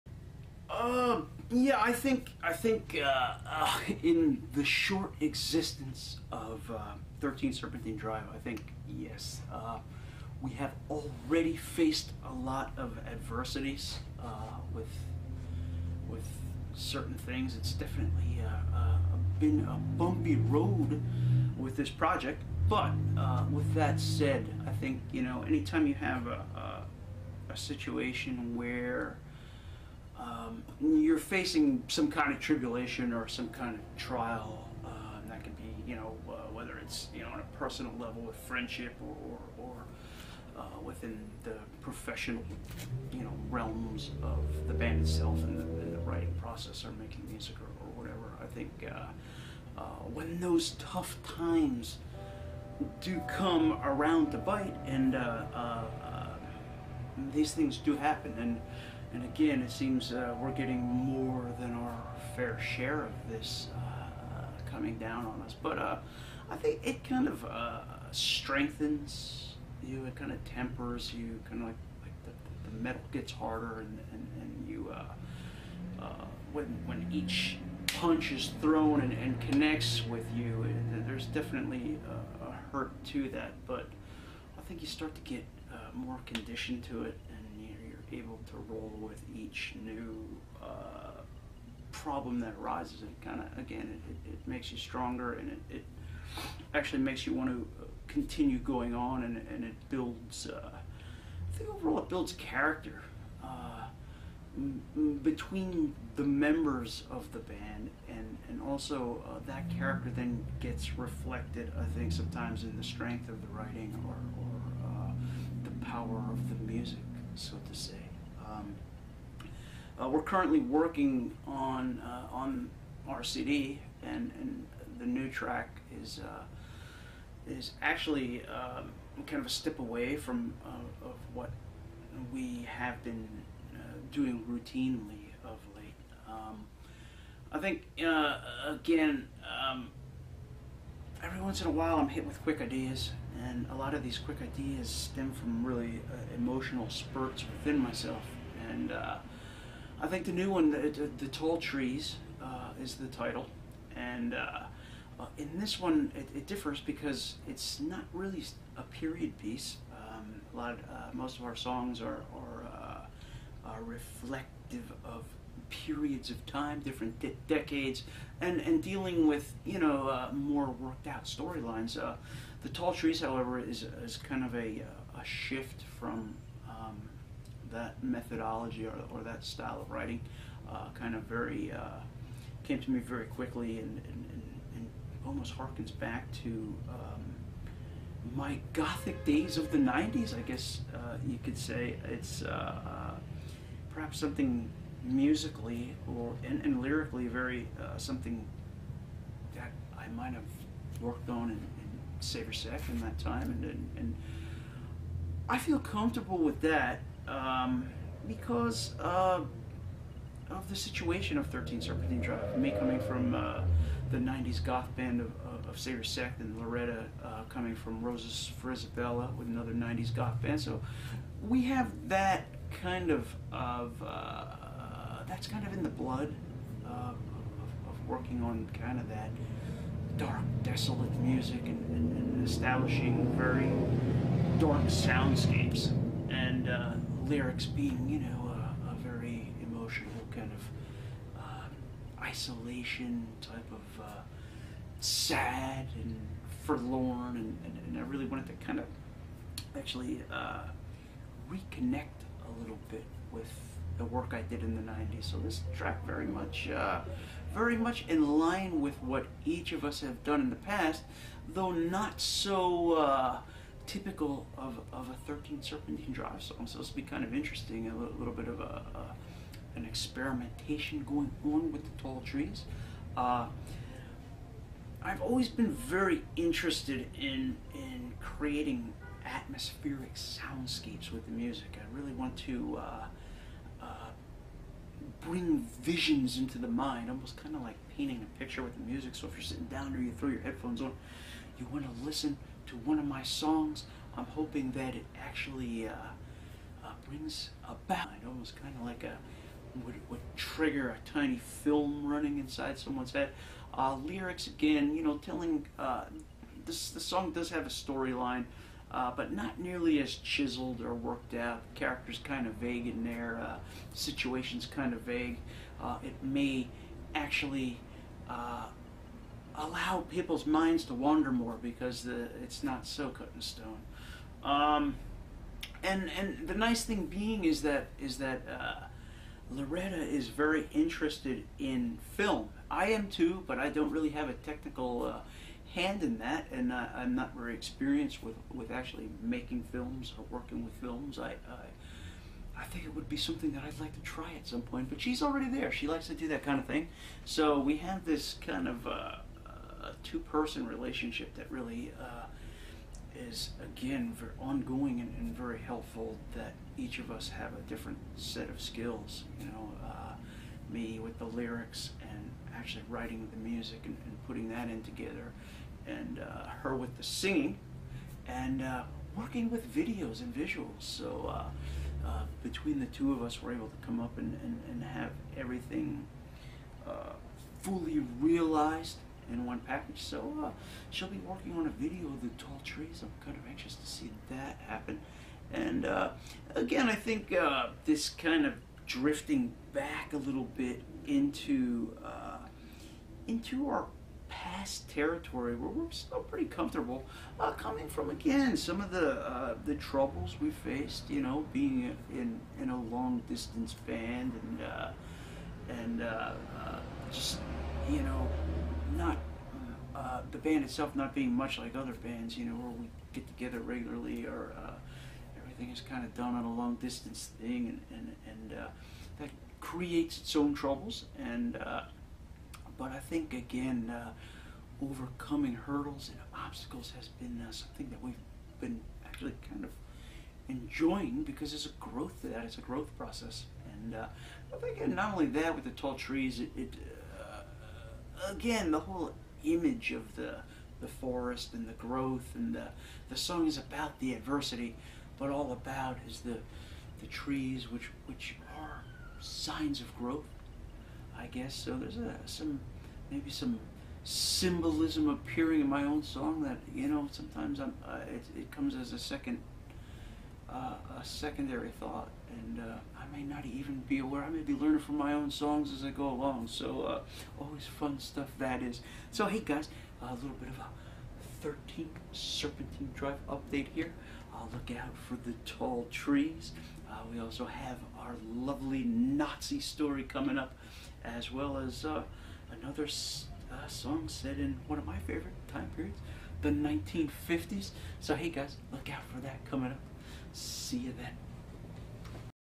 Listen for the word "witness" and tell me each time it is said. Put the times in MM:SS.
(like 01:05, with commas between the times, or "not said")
not said.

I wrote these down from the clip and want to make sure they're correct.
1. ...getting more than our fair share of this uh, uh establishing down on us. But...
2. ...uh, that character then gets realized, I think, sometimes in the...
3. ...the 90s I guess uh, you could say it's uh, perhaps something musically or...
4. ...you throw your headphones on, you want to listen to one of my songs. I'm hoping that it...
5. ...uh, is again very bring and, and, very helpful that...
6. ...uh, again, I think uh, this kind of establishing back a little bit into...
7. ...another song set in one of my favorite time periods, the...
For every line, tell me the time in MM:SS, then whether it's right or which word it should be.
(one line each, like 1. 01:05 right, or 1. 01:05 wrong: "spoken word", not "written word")
1. 01:00 wrong: "coming", not "establishing"
2. 01:49 wrong: "reflected", not "realized"
3. 03:09 right
4. 04:50 right
5. 05:51 wrong: "ongoing", not "bring"
6. 06:25 wrong: "drifting", not "establishing"
7. 08:02 right.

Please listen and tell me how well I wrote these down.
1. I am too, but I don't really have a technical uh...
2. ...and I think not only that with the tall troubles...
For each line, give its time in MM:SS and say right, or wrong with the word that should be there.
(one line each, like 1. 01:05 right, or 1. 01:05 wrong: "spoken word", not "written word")
1. 05:32 right
2. 07:13 wrong: "trees", not "troubles".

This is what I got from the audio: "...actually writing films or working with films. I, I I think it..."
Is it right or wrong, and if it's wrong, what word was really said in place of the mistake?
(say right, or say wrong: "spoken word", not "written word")
wrong: "making", not "writing".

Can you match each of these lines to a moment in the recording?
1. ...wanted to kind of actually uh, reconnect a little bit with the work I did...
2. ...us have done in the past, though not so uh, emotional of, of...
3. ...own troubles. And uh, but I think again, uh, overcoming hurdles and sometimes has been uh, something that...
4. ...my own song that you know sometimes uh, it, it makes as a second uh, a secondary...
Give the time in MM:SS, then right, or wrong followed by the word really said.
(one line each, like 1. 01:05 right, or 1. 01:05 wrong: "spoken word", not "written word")
1. 04:08 right
2. 04:19 wrong: "typical", not "emotional"
3. 07:00 wrong: "obstacles", not "sometimes"
4. 07:35 wrong: "comes", not "makes".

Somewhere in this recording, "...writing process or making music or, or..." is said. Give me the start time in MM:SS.
00:45.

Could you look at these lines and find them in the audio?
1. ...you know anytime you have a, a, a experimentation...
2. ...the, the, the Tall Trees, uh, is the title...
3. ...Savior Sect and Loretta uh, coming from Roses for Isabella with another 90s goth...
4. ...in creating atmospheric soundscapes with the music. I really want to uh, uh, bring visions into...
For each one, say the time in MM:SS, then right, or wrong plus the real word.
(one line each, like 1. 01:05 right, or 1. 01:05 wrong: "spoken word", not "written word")
1. 00:25 wrong: "situation", not "experimentation"
2. 02:30 right
3. 03:35 right
4. 04:37 right.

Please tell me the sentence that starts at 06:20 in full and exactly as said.
So uh, she'll be working on a video of the tall trees.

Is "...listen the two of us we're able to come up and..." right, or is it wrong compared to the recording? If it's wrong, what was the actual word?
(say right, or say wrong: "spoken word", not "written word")
wrong: "between", not "listen".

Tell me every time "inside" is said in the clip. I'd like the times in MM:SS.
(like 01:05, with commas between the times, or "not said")
05:02.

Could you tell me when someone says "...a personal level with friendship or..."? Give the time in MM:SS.
00:37.